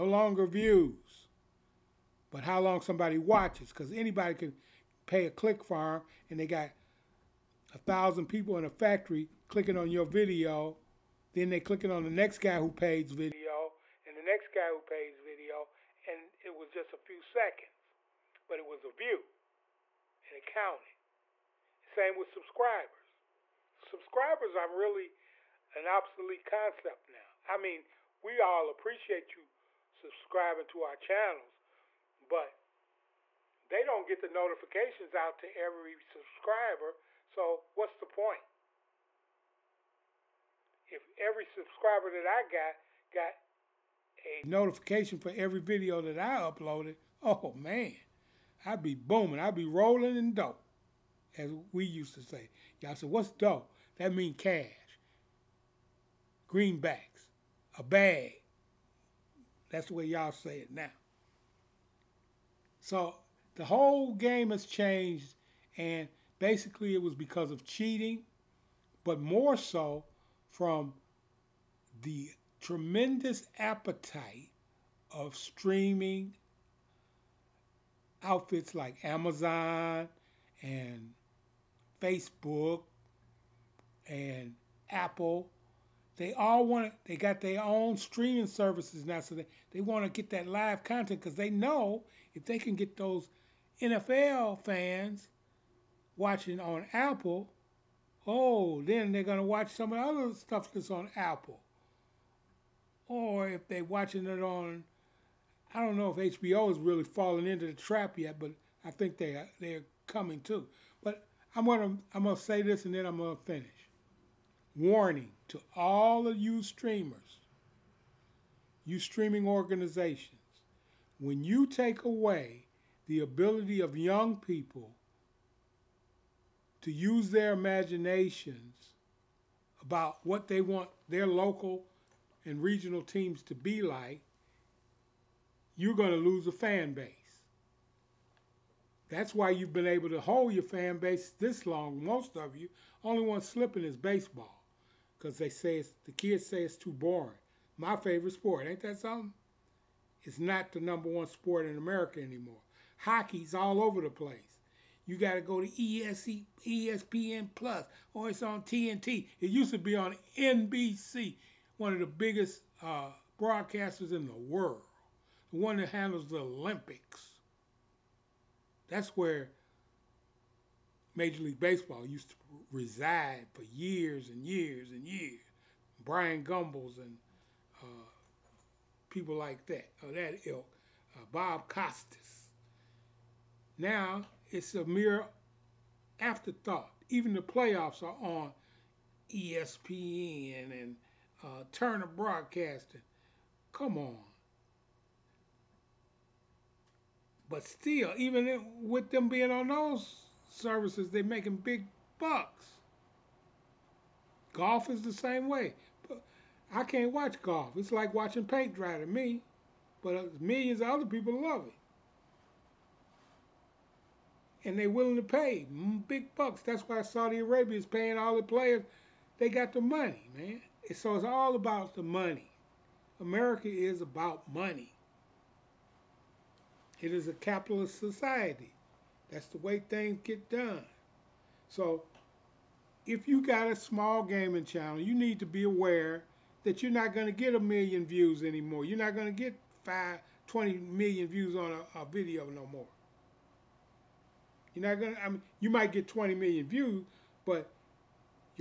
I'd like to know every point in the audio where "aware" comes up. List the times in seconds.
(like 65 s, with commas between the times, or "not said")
235 s.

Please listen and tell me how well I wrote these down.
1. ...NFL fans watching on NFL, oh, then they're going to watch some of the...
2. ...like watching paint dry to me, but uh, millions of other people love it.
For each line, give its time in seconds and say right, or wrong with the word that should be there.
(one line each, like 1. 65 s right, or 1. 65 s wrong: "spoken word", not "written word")
1. 93 s wrong: "Apple", not "NFL"
2. 207 s right.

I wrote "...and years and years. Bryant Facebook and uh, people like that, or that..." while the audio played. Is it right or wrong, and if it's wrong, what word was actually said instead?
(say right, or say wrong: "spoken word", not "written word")
wrong: "Gumbels", not "Facebook".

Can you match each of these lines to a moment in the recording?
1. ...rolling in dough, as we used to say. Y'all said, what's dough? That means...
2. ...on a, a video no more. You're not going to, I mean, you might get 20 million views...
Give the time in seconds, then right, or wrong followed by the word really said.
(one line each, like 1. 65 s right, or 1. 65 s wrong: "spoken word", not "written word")
1. 49 s right
2. 241 s right.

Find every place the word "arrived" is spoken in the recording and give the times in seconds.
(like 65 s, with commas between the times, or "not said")
not said.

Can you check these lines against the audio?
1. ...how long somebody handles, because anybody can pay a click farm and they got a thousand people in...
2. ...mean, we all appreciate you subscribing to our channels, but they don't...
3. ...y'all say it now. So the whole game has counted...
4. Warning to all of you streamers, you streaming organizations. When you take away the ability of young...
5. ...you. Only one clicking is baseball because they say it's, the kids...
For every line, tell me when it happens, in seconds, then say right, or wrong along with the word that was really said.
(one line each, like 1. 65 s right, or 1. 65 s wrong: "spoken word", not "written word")
1. 2 s wrong: "watches", not "handles"
2. 27 s right
3. 60 s wrong: "changed", not "counted"
4. 114 s right
5. 142 s wrong: "slipping", not "clicking".